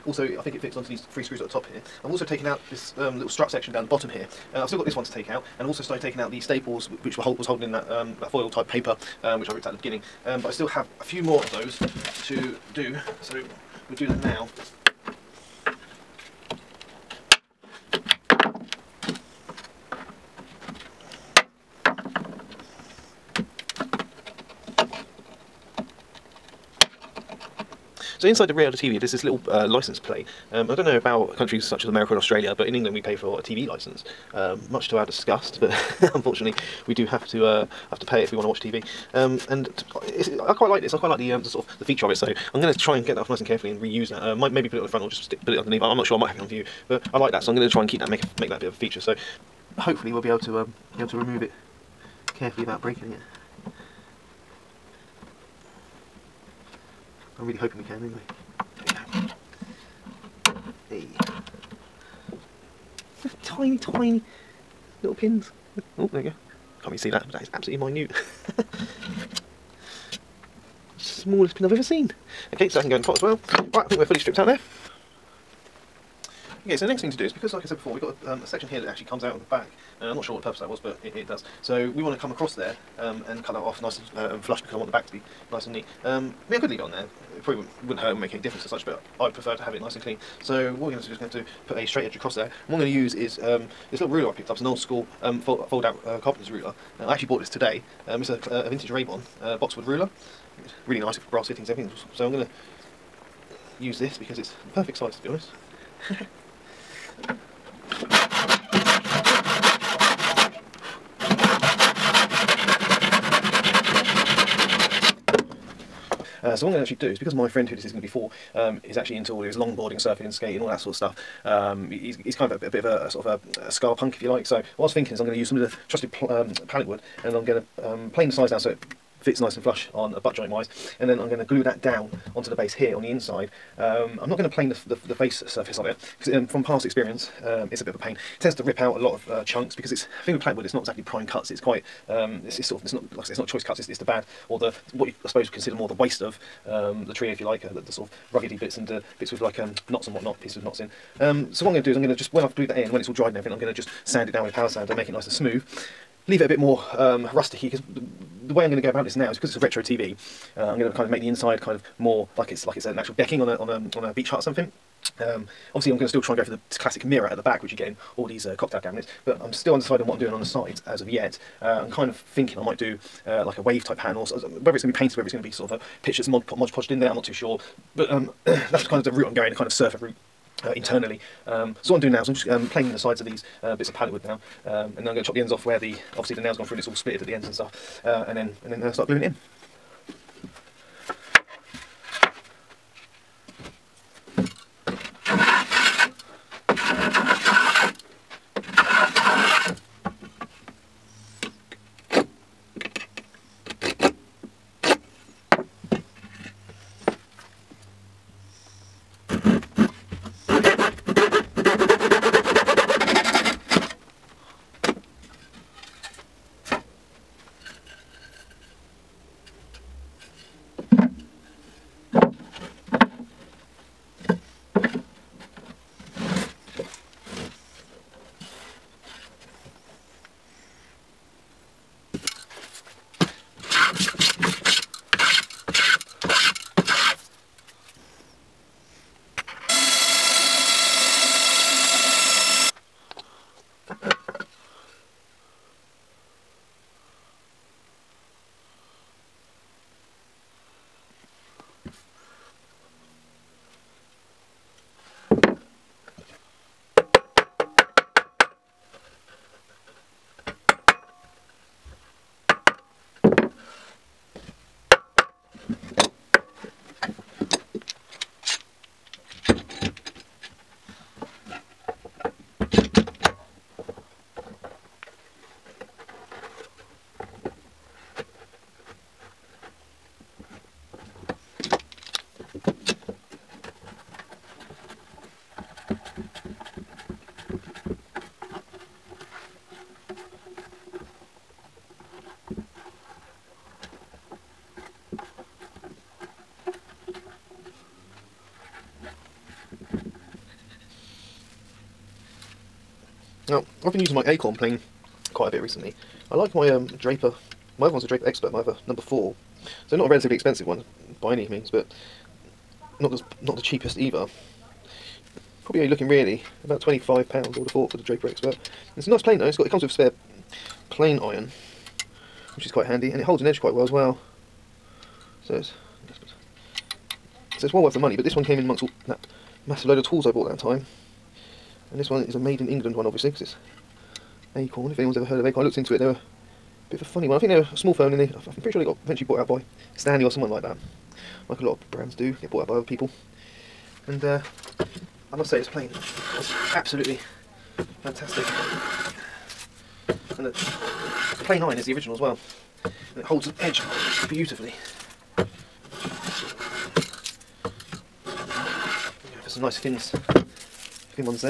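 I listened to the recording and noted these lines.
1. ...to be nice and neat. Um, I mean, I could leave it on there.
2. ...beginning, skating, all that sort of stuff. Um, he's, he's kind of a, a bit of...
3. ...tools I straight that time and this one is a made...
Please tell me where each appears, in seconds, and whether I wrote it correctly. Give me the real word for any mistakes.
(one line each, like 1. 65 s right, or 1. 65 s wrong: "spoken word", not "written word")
1. 85 s right
2. 119 s wrong: "surfing", not "beginning"
3. 330 s wrong: "bought", not "straight".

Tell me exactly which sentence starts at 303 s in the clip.
Now, I've been using my Acorn plane quite a bit recently.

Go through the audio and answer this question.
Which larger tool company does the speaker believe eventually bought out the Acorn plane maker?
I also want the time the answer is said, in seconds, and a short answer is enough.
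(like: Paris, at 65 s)
Stanley, at 339 s.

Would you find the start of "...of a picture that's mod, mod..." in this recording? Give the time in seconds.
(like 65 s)
175 s.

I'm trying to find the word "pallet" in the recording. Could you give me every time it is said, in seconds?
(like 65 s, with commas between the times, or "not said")
126 s, 183 s.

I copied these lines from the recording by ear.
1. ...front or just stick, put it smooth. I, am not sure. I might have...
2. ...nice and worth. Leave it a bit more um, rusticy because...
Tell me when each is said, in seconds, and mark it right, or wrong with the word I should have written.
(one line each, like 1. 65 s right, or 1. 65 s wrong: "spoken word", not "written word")
1. 44 s wrong: "underneath", not "smooth"
2. 155 s wrong: "smooth", not "worth".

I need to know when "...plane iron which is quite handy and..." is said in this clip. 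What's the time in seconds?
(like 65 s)
320 s.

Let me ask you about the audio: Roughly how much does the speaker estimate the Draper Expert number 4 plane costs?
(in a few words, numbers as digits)
£25.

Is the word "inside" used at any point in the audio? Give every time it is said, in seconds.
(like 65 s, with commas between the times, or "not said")
28 s, 133 s, 161 s.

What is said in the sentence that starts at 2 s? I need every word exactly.
I've also taken out this um, little strut section down the bottom here.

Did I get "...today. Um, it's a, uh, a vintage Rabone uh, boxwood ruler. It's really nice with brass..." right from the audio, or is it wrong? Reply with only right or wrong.
right.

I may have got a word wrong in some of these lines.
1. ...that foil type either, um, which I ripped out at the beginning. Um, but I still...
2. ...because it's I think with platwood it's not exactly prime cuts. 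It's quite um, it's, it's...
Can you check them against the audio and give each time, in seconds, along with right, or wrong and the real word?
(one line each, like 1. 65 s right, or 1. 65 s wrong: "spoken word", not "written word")
1. 8 s wrong: "paper", not "either"
2. 139 s right.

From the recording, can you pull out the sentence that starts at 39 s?
Um, and I quite like this.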